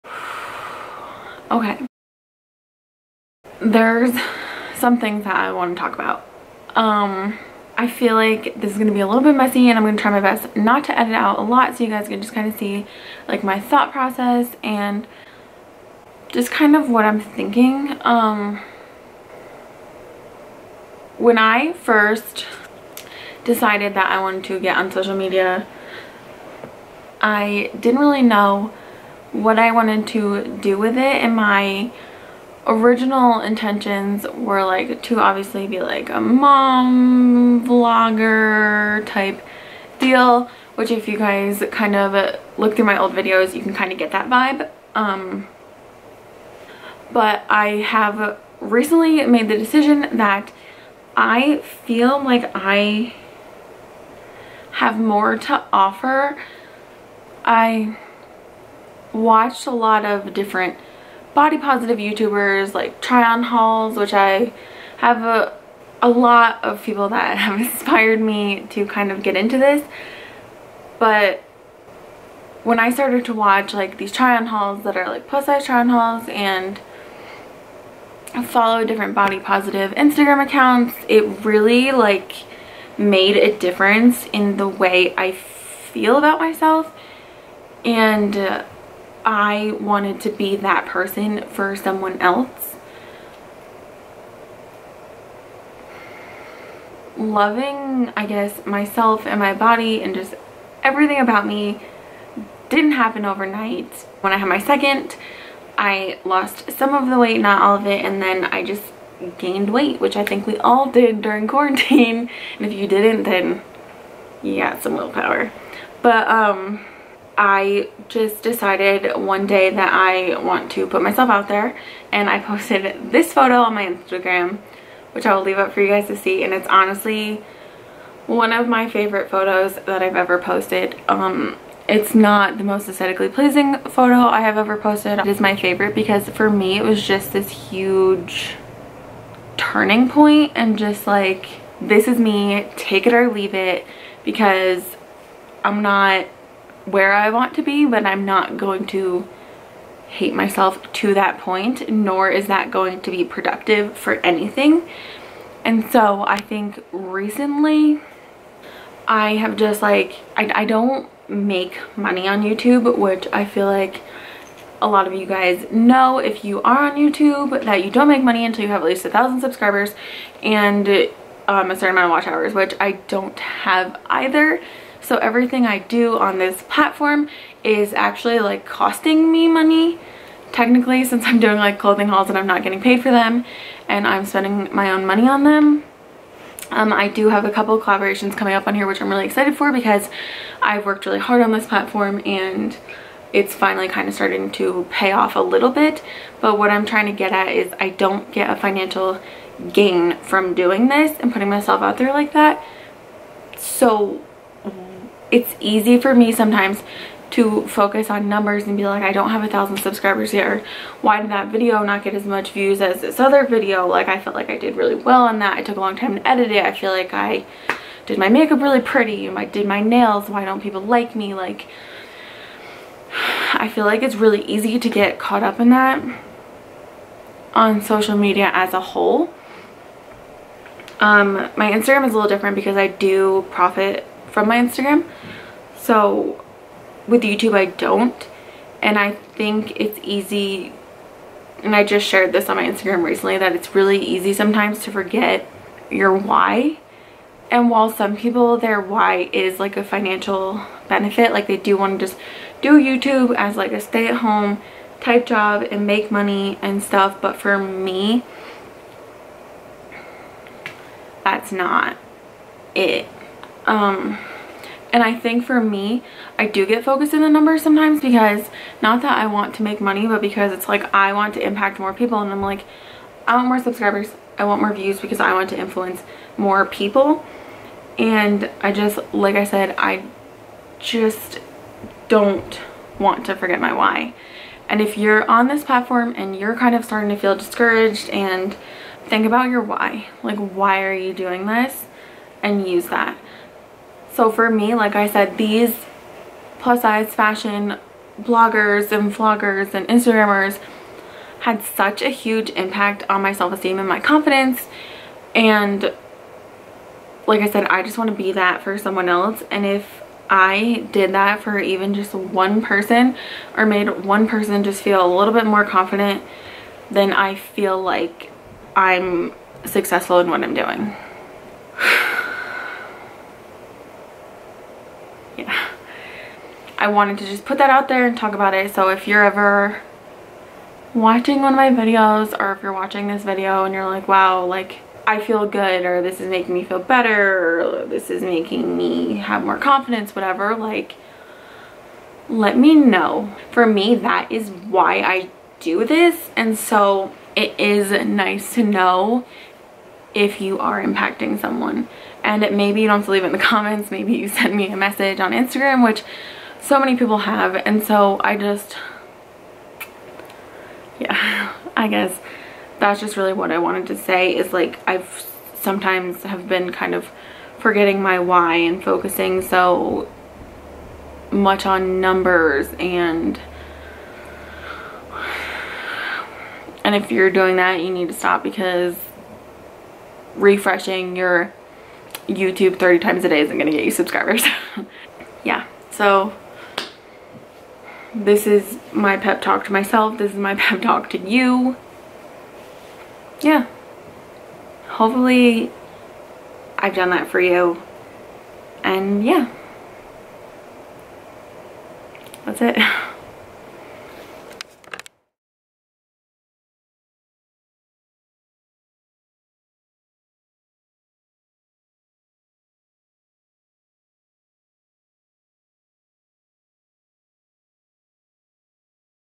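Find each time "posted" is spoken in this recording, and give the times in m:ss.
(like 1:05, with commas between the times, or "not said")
2:02, 2:10, 2:14.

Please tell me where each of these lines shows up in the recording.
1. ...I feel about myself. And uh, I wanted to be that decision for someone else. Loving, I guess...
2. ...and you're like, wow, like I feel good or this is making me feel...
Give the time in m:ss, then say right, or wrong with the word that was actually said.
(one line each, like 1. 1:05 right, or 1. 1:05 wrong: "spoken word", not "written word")
1. 1:25 wrong: "person", not "decision"
2. 5:33 right.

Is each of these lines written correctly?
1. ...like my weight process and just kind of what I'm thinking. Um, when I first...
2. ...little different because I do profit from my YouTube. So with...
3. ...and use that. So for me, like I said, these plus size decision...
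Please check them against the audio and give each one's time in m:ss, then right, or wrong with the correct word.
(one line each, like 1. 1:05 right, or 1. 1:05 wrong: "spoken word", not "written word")
1. 0:13 wrong: "thought", not "weight"
2. 3:52 wrong: "Instagram", not "YouTube"
3. 4:52 wrong: "fashion", not "decision".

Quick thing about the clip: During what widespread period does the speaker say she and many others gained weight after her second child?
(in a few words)
quarantine.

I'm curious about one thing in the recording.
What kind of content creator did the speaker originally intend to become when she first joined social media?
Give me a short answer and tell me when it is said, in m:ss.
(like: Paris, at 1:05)
mom vlogger, at 0:36.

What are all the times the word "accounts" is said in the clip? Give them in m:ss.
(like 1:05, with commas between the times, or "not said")
1:20.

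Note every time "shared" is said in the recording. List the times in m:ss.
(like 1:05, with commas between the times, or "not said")
4:02.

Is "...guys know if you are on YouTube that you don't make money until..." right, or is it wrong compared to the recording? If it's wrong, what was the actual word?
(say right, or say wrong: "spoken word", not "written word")
right.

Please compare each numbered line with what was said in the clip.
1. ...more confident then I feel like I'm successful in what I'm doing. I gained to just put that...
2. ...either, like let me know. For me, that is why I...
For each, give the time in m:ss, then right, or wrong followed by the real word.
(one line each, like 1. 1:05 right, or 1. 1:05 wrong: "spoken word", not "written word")
1. 5:15 wrong: "wanted", not "gained"
2. 5:40 wrong: "whatever", not "either".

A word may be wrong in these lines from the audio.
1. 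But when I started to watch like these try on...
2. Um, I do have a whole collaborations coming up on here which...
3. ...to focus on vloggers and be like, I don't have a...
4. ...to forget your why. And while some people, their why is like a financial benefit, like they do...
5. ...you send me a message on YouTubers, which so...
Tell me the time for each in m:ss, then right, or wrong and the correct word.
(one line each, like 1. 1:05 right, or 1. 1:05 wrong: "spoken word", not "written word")
1. 1:10 right
2. 3:06 wrong: "couple", not "whole"
3. 3:27 wrong: "numbers", not "vloggers"
4. 4:04 right
5. 5:54 wrong: "Instagram", not "YouTubers".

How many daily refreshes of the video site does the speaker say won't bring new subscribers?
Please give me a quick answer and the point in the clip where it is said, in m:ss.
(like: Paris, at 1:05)
30, at 6:22.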